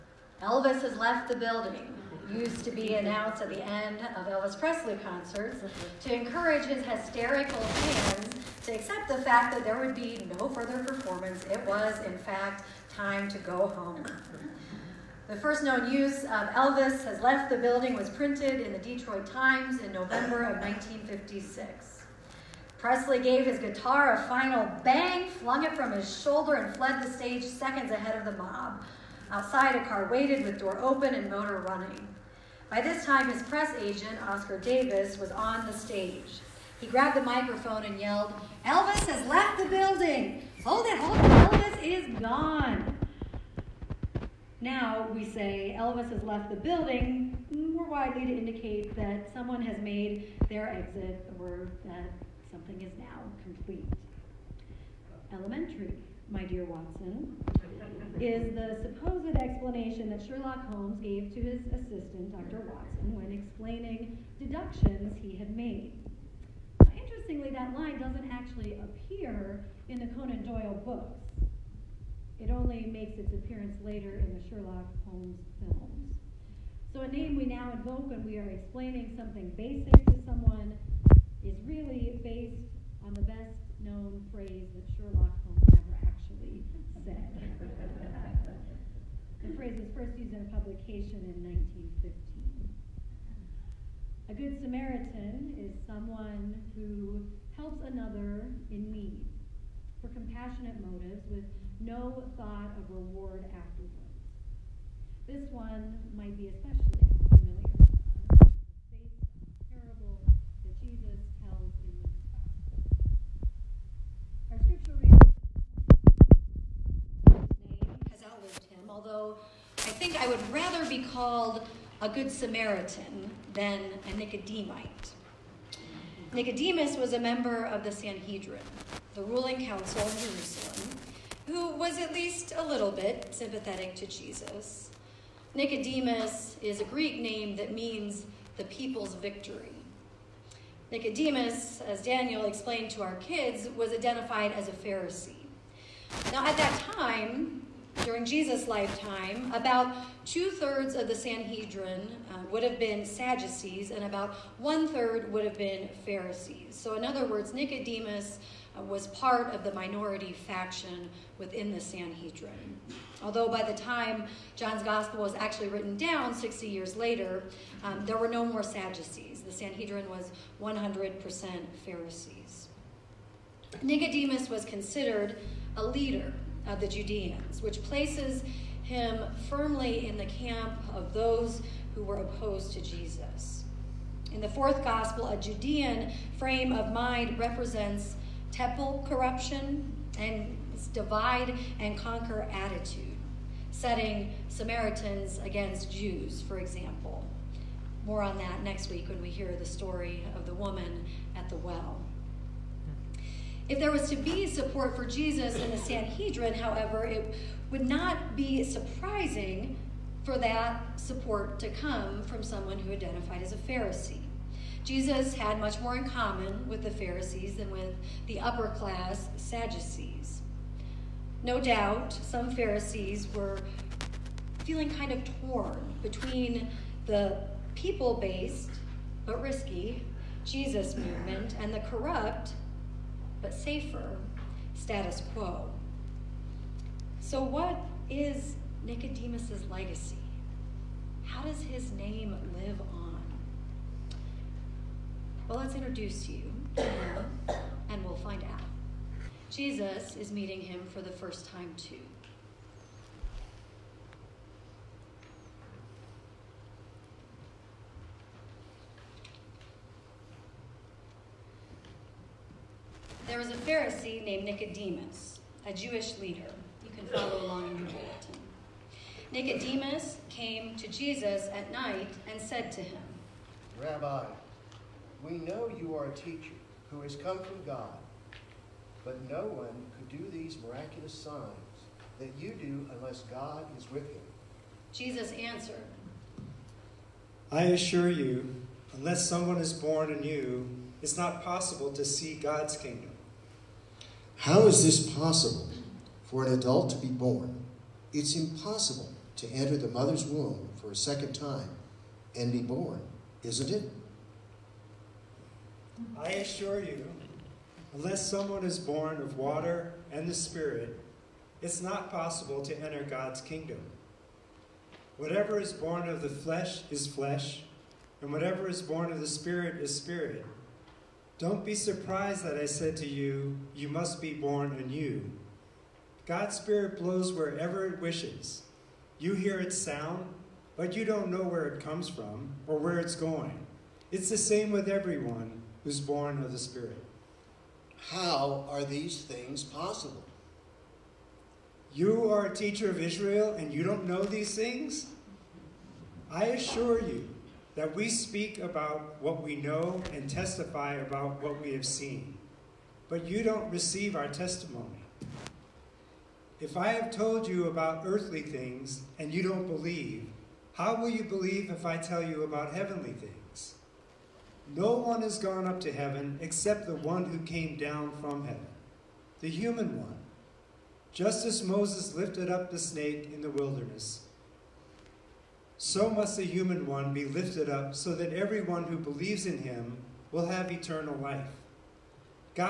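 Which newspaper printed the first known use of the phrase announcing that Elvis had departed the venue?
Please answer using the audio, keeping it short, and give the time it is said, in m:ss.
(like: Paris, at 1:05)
Detroit Times, at 0:18.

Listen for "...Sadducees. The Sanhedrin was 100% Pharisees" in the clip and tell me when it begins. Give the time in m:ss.
2:48.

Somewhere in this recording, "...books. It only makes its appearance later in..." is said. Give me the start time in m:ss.
1:10.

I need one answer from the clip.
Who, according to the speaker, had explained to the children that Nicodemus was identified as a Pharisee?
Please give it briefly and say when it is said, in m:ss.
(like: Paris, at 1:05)
Daniel, at 2:22.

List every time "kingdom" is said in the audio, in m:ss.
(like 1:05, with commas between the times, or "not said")
4:52, 5:13.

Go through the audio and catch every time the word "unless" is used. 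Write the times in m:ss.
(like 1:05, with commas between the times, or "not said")
4:42, 4:48, 5:07.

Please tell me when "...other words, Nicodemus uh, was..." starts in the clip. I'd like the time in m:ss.
2:37.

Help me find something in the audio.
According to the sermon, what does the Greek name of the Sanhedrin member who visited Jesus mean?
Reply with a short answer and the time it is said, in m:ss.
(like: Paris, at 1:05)
the people's victory, at 2:18.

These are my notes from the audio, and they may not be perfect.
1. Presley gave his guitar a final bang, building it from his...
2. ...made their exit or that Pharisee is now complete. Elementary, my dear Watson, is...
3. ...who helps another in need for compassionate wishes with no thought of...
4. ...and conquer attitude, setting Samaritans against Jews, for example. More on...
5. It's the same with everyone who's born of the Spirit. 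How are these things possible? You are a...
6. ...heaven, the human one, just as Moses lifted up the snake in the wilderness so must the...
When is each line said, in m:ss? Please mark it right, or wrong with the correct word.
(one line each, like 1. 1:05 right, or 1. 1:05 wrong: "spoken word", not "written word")
1. 0:22 wrong: "flung", not "building"
2. 0:49 wrong: "Something", not "Pharisee"
3. 1:36 wrong: "motives", not "wishes"
4. 3:11 right
5. 5:34 right
6. 6:08 right.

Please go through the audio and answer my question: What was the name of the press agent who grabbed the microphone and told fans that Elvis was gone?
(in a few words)
Oscar Davis.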